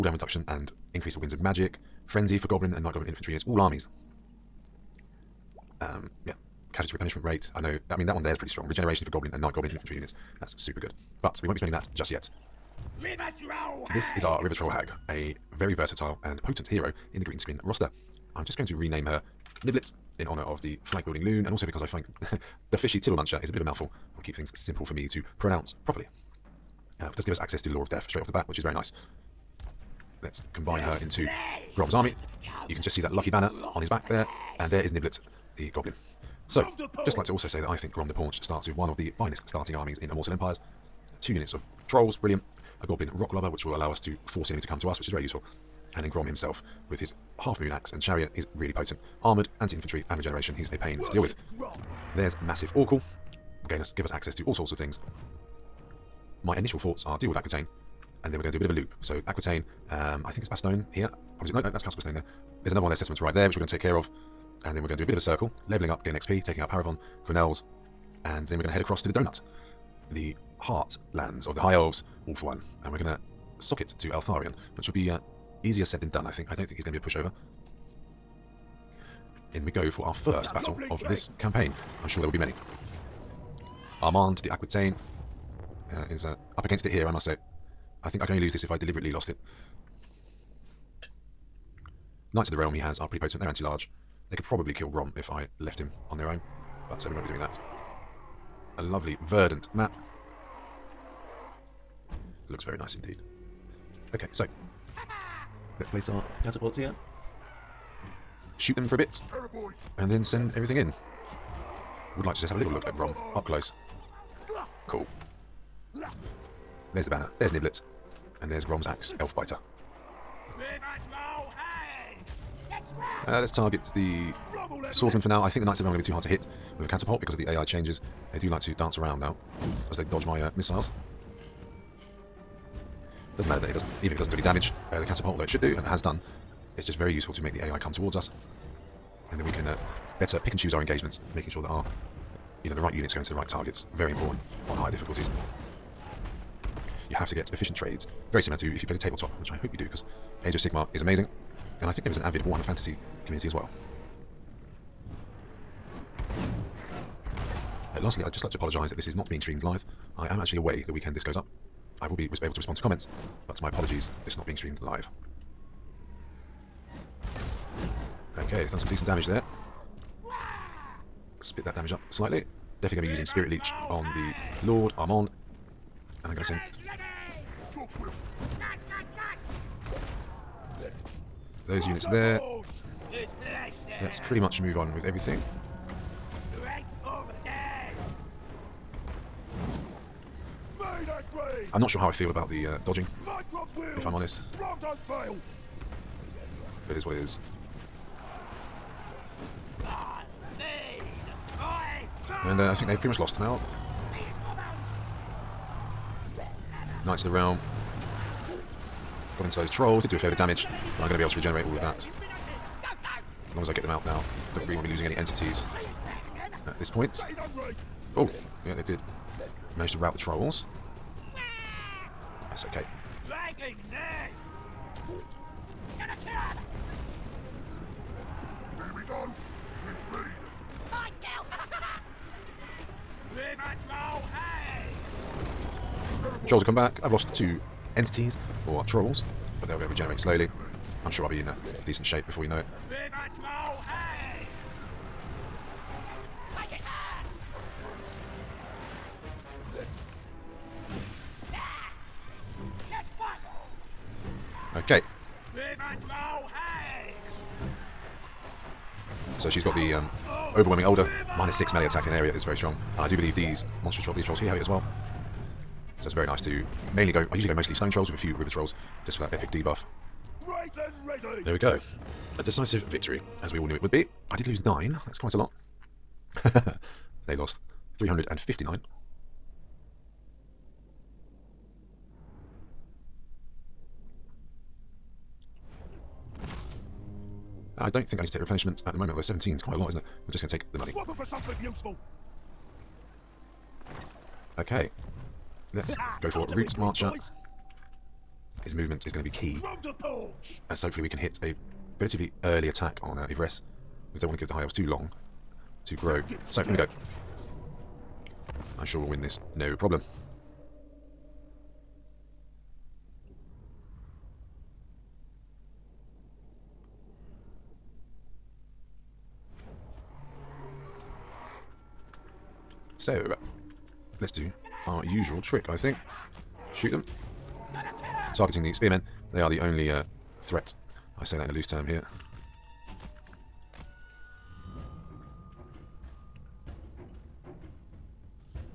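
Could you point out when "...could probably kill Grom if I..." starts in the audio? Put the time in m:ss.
1:34.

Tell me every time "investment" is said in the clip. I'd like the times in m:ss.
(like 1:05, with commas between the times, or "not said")
not said.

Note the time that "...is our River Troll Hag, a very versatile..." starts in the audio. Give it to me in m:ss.
0:14.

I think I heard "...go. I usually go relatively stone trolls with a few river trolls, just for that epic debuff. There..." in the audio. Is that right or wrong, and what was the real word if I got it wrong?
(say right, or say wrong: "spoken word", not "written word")
wrong: "mostly", not "relatively".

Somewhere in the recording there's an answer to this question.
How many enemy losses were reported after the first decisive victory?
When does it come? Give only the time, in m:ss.
4:37.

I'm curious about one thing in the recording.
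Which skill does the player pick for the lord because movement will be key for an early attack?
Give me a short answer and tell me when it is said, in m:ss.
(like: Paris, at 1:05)
Route Marcher, at 4:56.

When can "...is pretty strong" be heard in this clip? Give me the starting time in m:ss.
0:08.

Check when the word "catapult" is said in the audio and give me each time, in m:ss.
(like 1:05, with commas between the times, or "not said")
1:46, 2:06, 2:15.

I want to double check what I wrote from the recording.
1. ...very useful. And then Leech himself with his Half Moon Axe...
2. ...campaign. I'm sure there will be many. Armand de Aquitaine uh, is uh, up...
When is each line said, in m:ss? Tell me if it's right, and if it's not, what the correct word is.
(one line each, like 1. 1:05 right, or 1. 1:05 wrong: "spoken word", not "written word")
1. 0:45 wrong: "Grom", not "Leech"
2. 1:21 right.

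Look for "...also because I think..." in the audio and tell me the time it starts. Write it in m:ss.
0:21.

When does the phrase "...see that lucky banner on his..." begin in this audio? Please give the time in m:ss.
0:32.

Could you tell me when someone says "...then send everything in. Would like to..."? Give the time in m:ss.
1:50.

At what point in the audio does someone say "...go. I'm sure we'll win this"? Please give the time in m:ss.
5:06.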